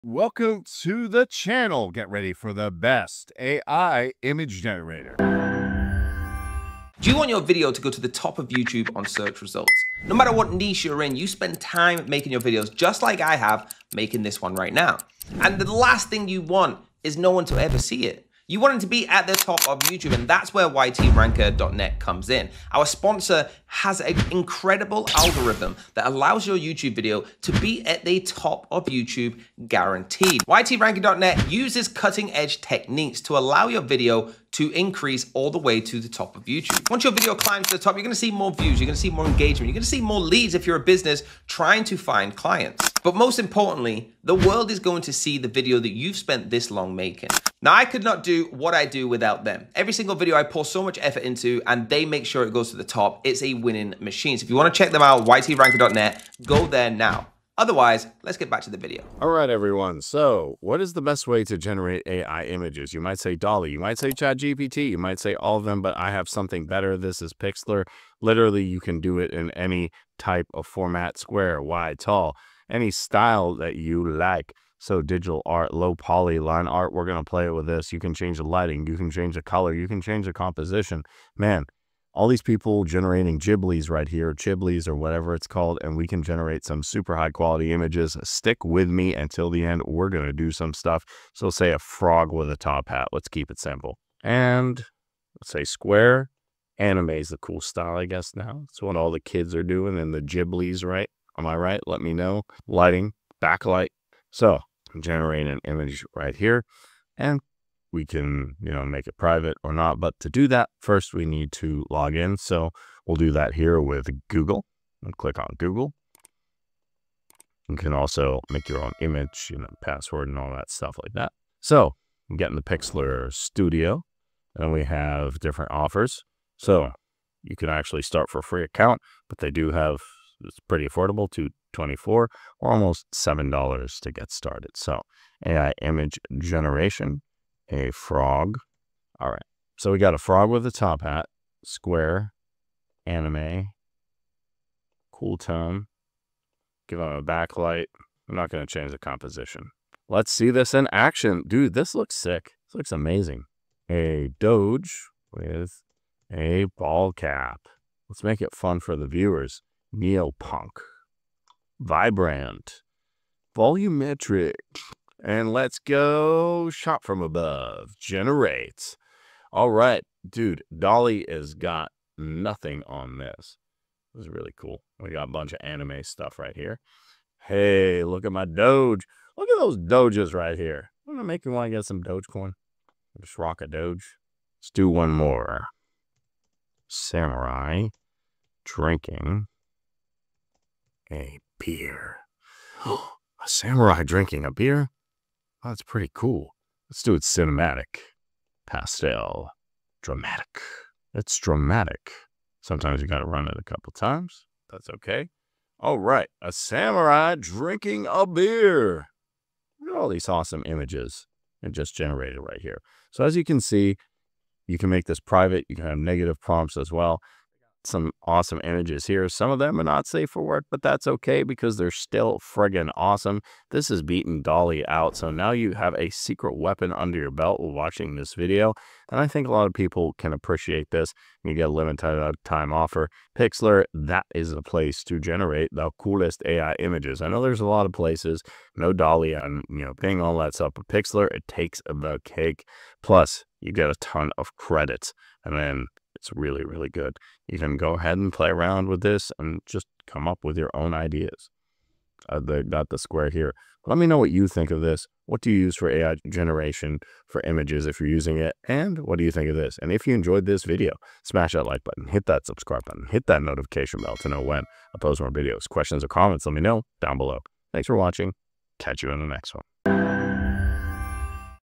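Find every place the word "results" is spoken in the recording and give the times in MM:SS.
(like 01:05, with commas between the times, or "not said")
00:09.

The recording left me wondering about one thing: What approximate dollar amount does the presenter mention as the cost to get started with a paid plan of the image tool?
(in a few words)
$7.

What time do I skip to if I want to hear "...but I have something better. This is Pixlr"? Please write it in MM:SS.
01:05.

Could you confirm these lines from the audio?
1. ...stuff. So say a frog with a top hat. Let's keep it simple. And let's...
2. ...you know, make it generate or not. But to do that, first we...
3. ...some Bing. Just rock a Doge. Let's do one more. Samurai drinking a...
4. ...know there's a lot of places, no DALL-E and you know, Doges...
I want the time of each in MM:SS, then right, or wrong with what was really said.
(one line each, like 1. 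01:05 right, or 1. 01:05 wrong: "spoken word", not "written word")
1. 01:30 right
2. 01:48 wrong: "private", not "generate"
3. 03:01 wrong: "Dogecoin", not "Bing"
4. 03:57 wrong: "Bing", not "Doges".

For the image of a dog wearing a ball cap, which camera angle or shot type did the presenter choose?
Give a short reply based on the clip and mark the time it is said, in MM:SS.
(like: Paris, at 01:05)
Shot from above, at 02:46.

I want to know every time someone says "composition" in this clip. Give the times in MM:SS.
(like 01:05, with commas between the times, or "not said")
01:20, 02:28.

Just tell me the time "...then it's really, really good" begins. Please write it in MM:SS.
04:05.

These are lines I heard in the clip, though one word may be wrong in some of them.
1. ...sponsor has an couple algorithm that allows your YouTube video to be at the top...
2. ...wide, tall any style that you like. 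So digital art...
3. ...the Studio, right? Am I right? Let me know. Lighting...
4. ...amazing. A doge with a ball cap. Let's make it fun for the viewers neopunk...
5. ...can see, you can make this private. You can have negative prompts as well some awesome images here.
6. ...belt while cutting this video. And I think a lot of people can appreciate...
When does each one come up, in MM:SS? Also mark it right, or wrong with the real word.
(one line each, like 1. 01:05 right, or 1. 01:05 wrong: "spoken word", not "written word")
1. 00:22 wrong: "incredible", not "couple"
2. 01:11 right
3. 01:40 wrong: "Ghiblis", not "Studio"
4. 02:32 right
5. 03:33 right
6. 03:47 wrong: "watching", not "cutting".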